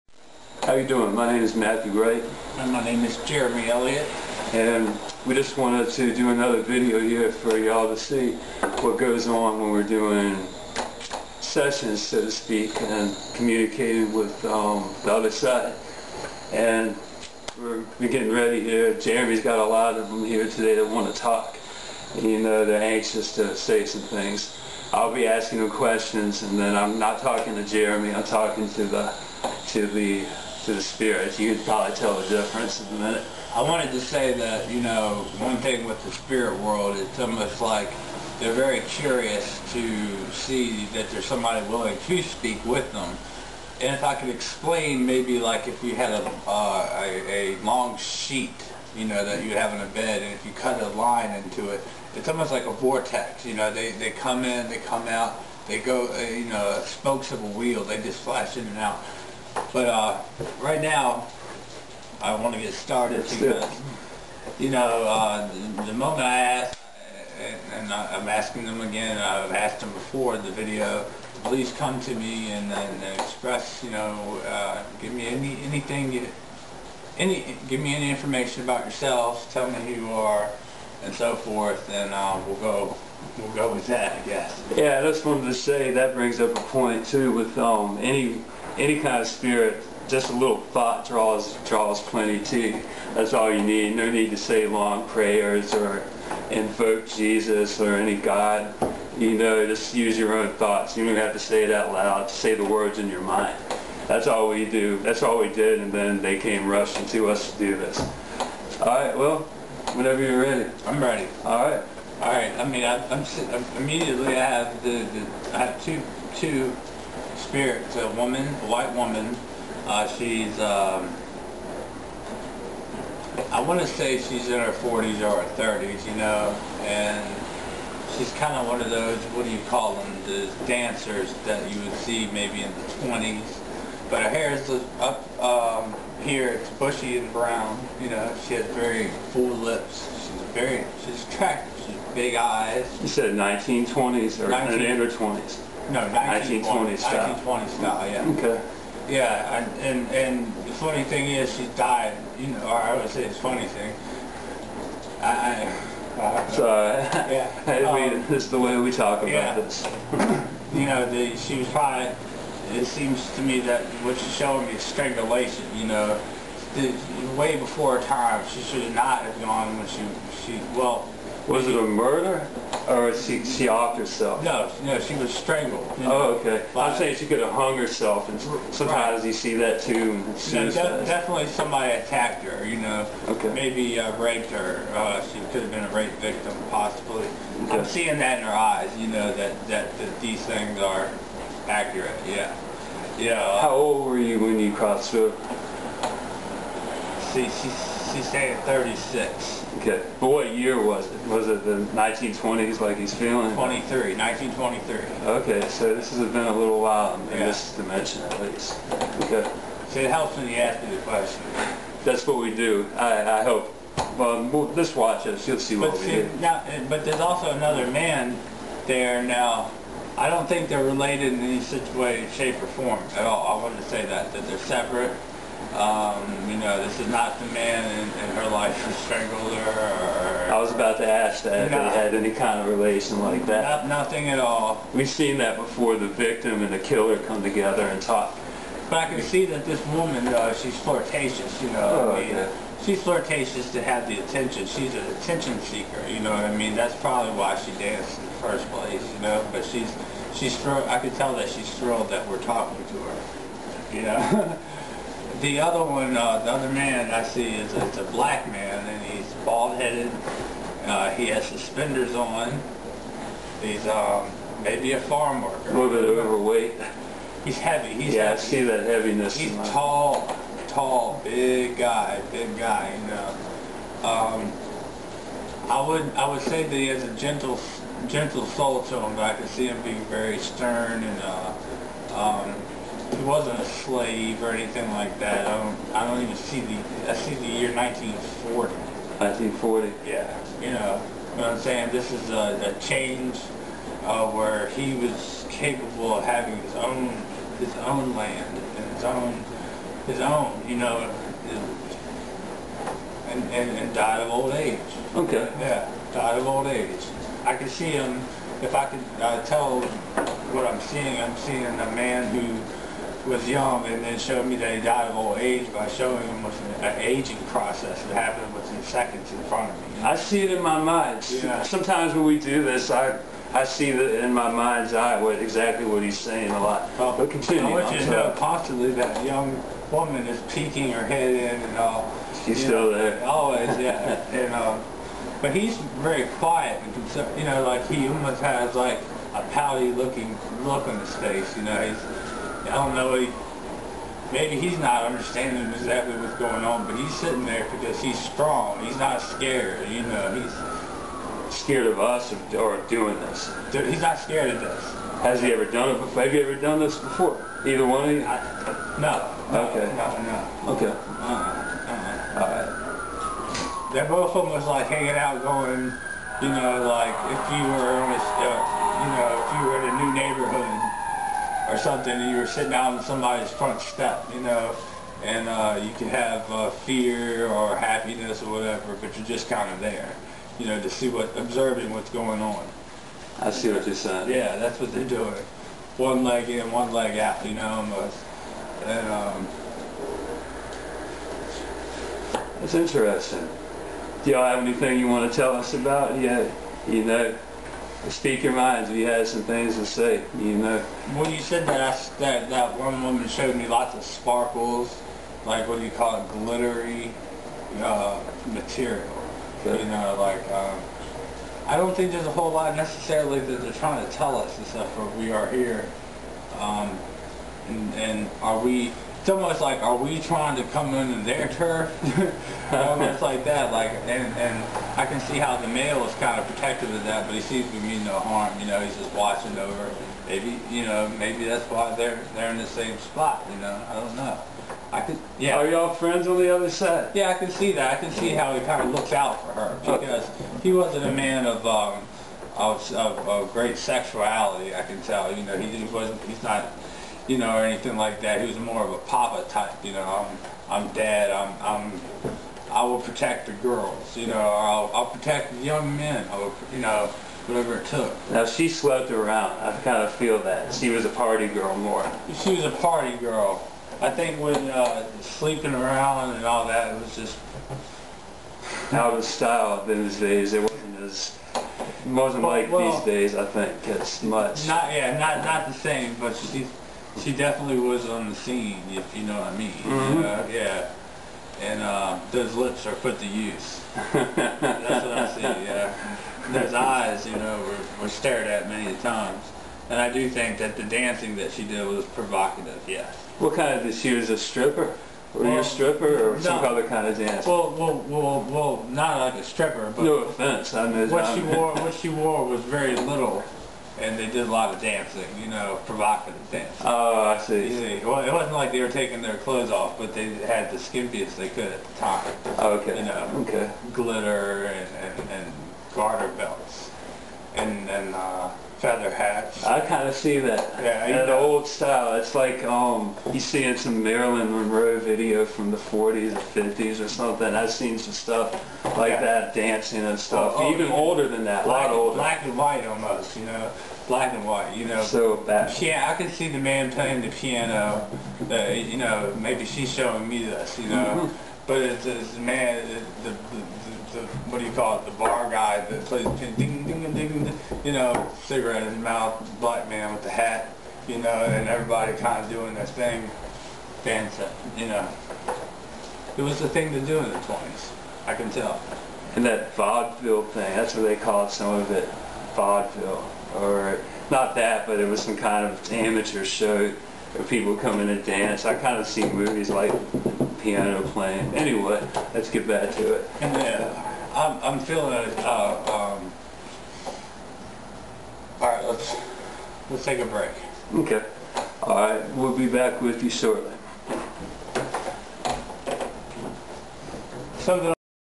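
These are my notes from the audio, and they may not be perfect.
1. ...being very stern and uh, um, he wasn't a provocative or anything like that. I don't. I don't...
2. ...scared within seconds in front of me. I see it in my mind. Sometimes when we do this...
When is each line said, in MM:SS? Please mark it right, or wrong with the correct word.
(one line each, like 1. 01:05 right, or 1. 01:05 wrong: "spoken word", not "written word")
1. 04:39 wrong: "slave", not "provocative"
2. 05:18 wrong: "happened", not "scared".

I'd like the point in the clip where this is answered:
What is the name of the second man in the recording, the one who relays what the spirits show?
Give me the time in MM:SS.
00:03.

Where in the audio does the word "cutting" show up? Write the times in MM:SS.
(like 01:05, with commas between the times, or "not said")
not said.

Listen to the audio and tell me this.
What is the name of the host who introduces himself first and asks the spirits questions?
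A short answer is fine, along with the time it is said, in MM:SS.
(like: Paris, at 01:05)
Matthew Wright, at 00:01.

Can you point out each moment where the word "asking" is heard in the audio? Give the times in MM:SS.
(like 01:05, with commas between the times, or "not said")
00:25, 01:08.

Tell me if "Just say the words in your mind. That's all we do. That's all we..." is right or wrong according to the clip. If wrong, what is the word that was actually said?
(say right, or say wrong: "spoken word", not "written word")
right.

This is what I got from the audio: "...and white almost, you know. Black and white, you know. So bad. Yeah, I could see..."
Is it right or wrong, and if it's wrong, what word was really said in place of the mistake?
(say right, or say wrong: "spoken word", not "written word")
right.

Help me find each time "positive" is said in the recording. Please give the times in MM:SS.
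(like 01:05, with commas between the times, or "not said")
not said.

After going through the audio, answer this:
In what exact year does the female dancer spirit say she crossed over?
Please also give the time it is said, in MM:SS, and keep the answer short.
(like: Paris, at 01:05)
1923, at 03:24.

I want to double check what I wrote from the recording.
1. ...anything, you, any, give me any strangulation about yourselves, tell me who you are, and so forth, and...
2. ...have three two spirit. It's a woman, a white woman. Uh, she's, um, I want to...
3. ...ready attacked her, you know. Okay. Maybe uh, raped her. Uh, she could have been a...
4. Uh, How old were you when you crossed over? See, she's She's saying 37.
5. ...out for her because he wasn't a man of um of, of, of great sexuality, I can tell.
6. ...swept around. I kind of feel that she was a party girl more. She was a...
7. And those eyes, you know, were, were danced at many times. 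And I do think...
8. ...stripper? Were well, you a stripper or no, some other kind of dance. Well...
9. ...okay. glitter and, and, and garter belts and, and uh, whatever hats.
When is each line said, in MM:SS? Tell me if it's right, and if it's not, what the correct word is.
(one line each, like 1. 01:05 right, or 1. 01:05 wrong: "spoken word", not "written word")
1. 01:15 wrong: "information", not "strangulation"
2. 01:55 wrong: "two", not "three"
3. 03:01 wrong: "somebody", not "ready"
4. 03:13 wrong: "36", not "37"
5. 07:19 right
6. 07:38 right
7. 08:06 wrong: "stared", not "danced"
8. 08:14 right
9. 08:33 wrong: "feather", not "whatever".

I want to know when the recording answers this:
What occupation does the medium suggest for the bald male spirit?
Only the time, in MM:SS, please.
04:25.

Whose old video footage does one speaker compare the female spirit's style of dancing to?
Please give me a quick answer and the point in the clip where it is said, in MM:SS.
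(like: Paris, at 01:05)
Marilyn Monroe, at 08:44.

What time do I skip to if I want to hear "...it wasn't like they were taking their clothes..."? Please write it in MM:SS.
08:28.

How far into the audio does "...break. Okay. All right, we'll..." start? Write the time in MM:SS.
09:40.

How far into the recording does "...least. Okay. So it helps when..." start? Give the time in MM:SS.
03:28.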